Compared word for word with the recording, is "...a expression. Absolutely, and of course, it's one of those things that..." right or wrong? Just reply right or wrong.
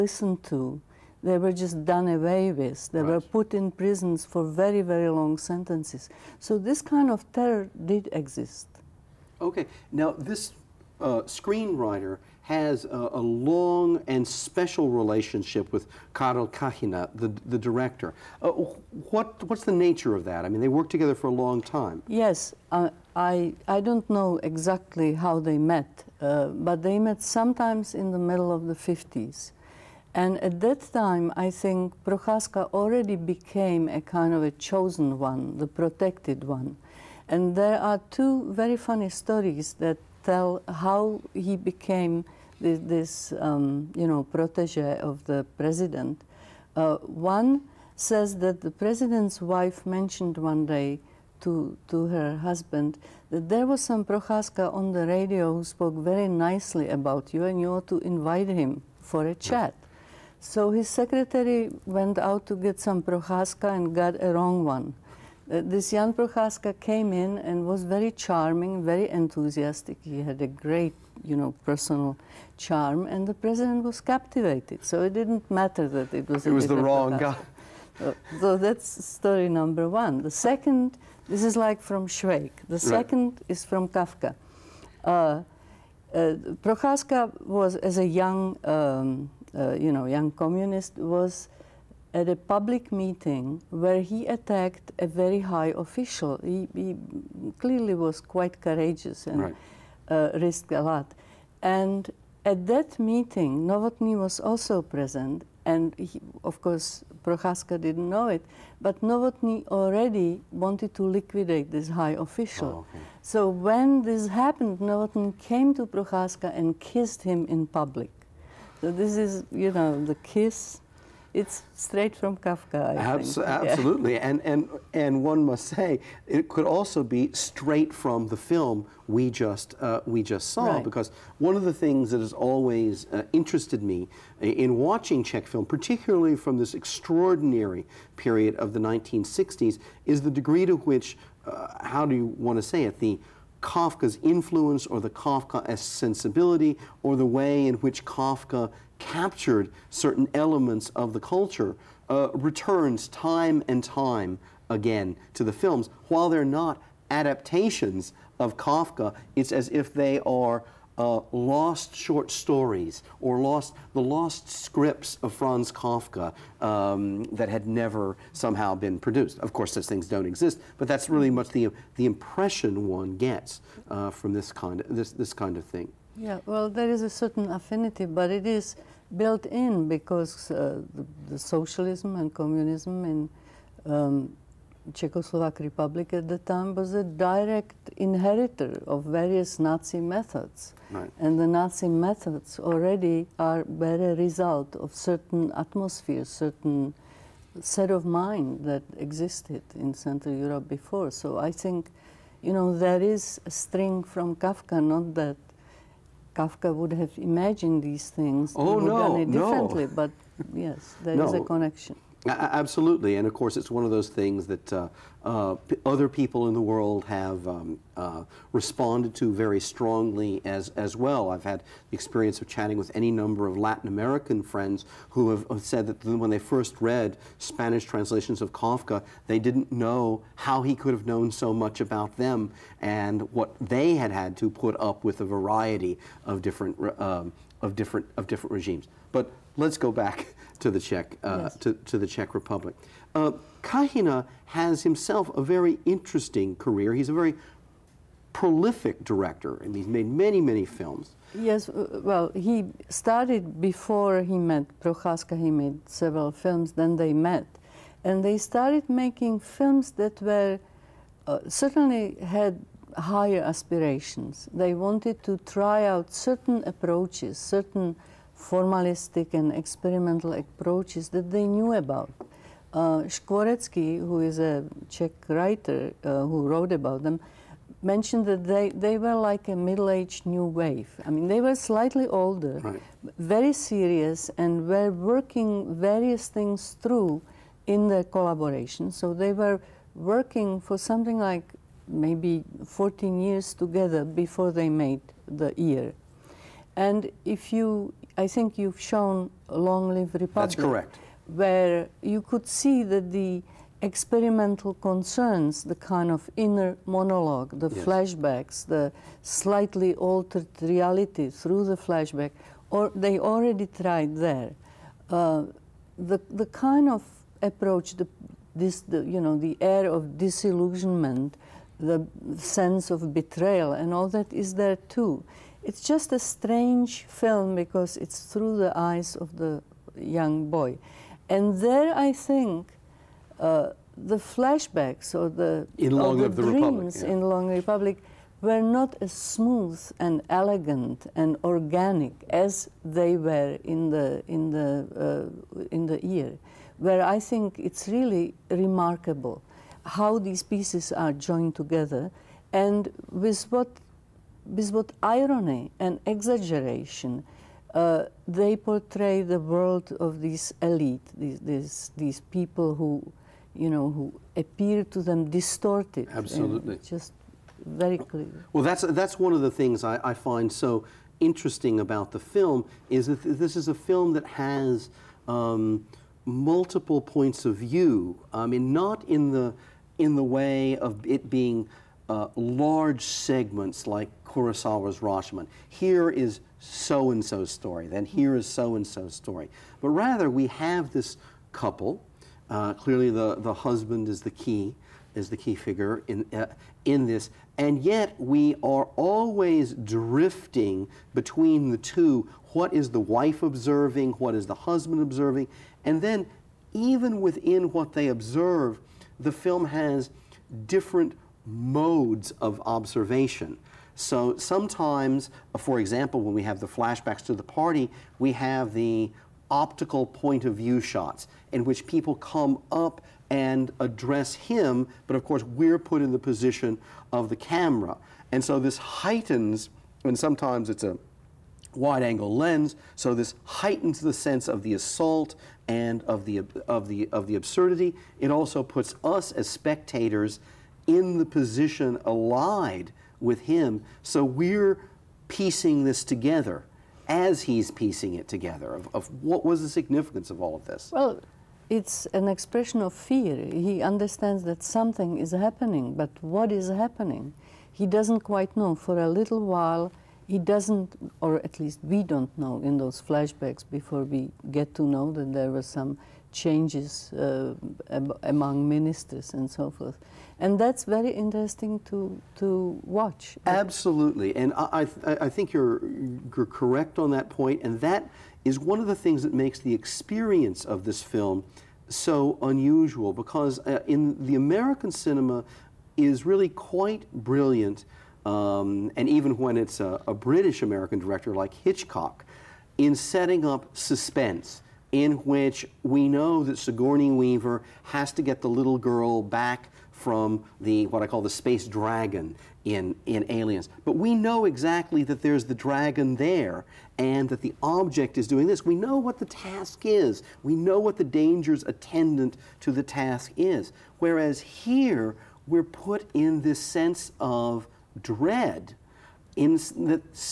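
wrong.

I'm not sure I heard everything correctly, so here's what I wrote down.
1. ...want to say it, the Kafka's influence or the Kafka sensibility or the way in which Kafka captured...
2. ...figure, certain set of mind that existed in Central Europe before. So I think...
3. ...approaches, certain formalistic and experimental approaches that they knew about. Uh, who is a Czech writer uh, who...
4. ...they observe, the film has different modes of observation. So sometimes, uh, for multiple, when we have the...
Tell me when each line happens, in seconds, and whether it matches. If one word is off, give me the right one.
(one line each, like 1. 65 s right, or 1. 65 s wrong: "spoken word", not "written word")
1. 142 s right
2. 195 s wrong: "atmosphere", not "figure"
3. 266 s right
4. 407 s wrong: "example", not "multiple".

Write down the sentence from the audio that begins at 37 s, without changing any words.
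And there are two very funny stories that tell how he became this, this um, you know, protege of the president.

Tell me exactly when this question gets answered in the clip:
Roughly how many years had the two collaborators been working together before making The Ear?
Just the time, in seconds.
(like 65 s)
292 s.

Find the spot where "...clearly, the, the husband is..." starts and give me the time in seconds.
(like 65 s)
392 s.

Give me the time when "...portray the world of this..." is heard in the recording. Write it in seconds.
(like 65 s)
358 s.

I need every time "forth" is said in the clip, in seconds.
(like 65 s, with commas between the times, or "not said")
469 s.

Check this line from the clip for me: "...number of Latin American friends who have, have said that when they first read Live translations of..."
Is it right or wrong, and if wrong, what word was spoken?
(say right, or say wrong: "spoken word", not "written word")
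wrong: "Spanish", not "Live".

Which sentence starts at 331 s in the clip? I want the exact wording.
And there, I think, uh, the flashbacks or the, in or the, the dreams Republic, yeah.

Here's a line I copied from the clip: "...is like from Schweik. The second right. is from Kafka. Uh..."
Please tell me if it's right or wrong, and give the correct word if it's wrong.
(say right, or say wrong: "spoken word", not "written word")
right.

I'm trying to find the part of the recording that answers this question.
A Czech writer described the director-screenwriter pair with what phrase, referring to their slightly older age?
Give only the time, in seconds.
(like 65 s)
279 s.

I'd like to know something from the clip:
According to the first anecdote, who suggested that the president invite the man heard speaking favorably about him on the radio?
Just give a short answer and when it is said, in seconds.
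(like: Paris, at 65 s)
The president's wife, at 48 s.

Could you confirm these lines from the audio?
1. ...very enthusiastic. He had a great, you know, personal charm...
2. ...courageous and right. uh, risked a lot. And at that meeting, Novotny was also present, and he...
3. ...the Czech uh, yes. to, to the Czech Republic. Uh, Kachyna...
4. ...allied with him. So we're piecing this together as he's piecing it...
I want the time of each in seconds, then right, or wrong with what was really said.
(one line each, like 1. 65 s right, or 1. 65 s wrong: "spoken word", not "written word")
1. 68 s right
2. 98 s right
3. 240 s right
4. 442 s right.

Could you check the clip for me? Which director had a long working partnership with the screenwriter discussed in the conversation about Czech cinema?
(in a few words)
Karel Kachyna.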